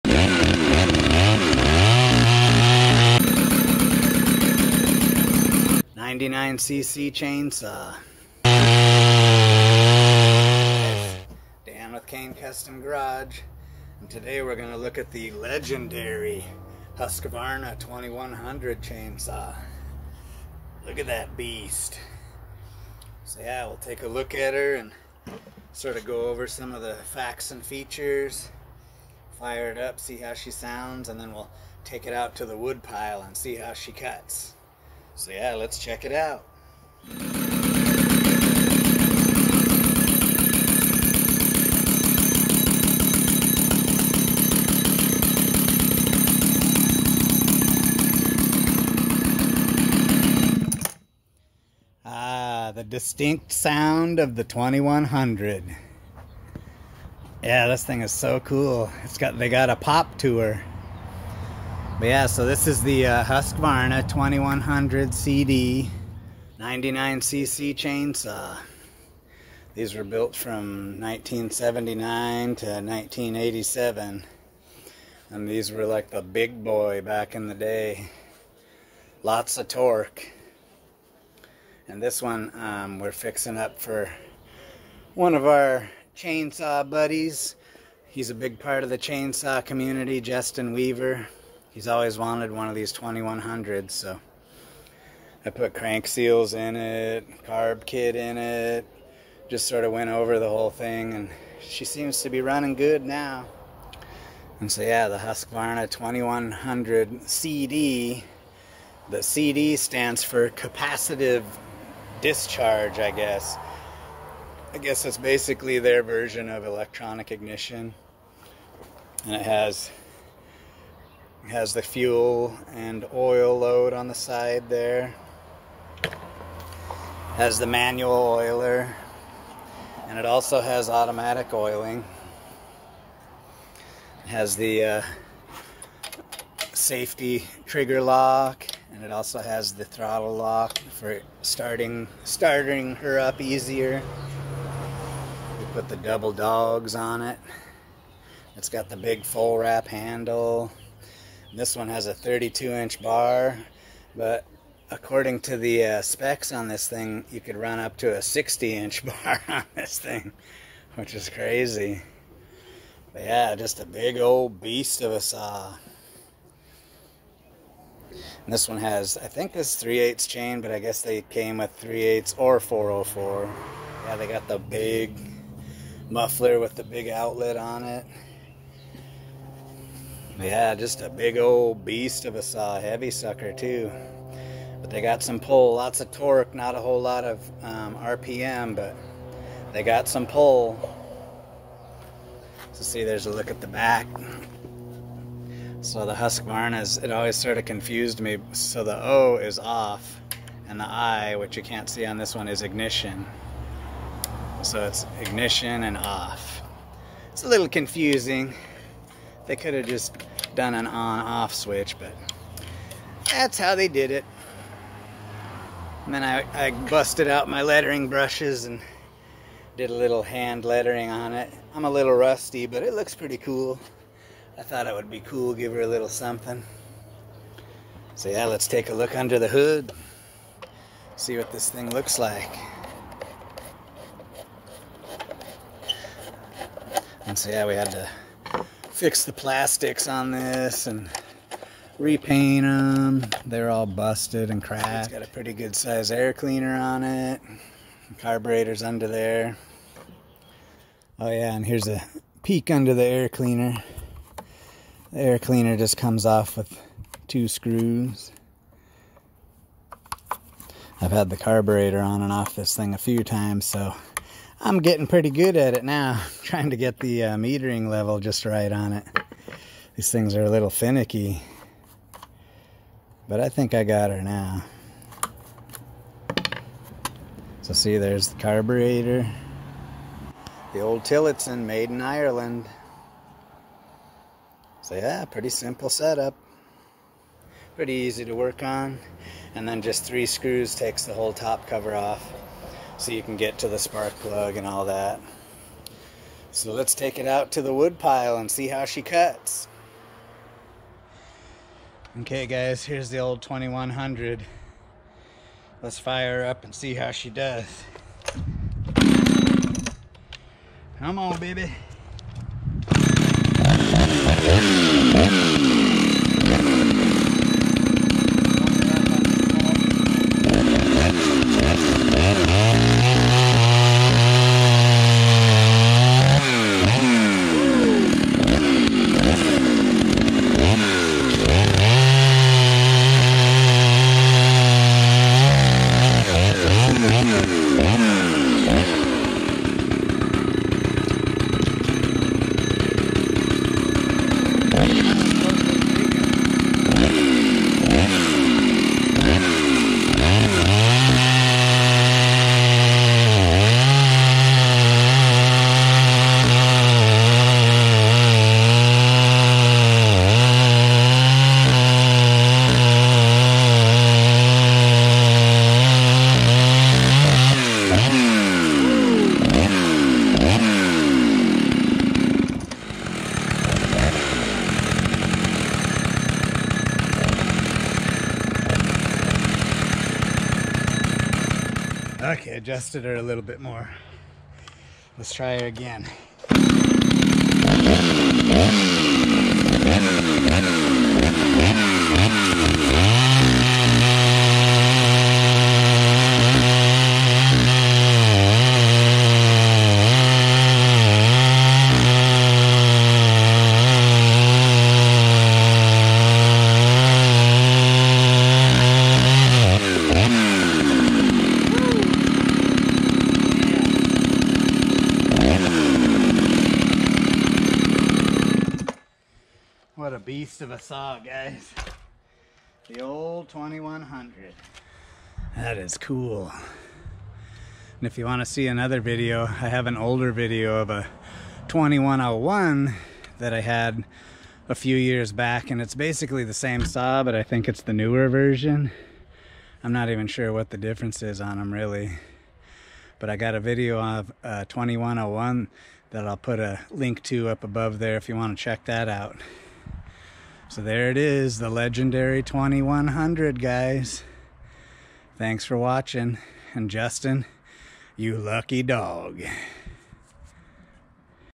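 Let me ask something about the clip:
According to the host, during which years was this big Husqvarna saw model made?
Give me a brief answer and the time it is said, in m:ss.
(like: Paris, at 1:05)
1979 to 1987, at 1:10.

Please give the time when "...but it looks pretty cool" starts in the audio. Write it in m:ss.
3:42.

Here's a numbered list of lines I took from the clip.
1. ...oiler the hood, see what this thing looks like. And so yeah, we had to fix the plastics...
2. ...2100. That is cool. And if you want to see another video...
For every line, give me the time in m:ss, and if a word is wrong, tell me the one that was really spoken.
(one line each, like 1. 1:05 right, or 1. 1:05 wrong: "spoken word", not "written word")
1. 3:49 wrong: "under", not "oiler"
2. 7:03 right.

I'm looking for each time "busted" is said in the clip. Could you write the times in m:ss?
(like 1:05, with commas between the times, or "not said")
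3:36, 4:03.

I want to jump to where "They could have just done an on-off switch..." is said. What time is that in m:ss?
3:29.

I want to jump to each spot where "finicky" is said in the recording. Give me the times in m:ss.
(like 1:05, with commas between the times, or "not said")
4:30.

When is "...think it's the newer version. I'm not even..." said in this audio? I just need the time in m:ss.
7:17.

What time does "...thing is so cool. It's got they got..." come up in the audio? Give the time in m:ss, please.
0:57.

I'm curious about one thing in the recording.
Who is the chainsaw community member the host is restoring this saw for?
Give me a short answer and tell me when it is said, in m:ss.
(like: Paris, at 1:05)
Justin Weaver, at 1:30.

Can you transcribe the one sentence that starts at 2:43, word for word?
But yeah, just a big old beast of a saw.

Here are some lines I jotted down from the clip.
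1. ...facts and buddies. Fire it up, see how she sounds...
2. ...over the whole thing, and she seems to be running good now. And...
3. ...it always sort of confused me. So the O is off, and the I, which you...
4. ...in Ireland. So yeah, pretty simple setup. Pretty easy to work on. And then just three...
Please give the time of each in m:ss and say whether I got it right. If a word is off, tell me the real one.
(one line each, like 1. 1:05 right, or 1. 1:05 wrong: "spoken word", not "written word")
1. 0:27 wrong: "features", not "buddies"
2. 1:40 right
3. 3:16 right
4. 4:41 right.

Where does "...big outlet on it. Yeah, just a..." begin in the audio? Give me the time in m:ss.
2:56.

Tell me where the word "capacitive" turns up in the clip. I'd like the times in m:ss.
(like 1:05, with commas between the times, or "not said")
1:50.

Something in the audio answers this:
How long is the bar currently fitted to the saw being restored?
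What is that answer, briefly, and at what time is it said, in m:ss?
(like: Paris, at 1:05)
32 inch, at 2:32.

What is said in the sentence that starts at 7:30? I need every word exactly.
So there it is, the legendary 2100, guys.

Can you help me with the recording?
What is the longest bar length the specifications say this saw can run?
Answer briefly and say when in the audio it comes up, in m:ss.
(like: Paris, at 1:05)
60 inch, at 2:38.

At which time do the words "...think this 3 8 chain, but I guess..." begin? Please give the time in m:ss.
2:49.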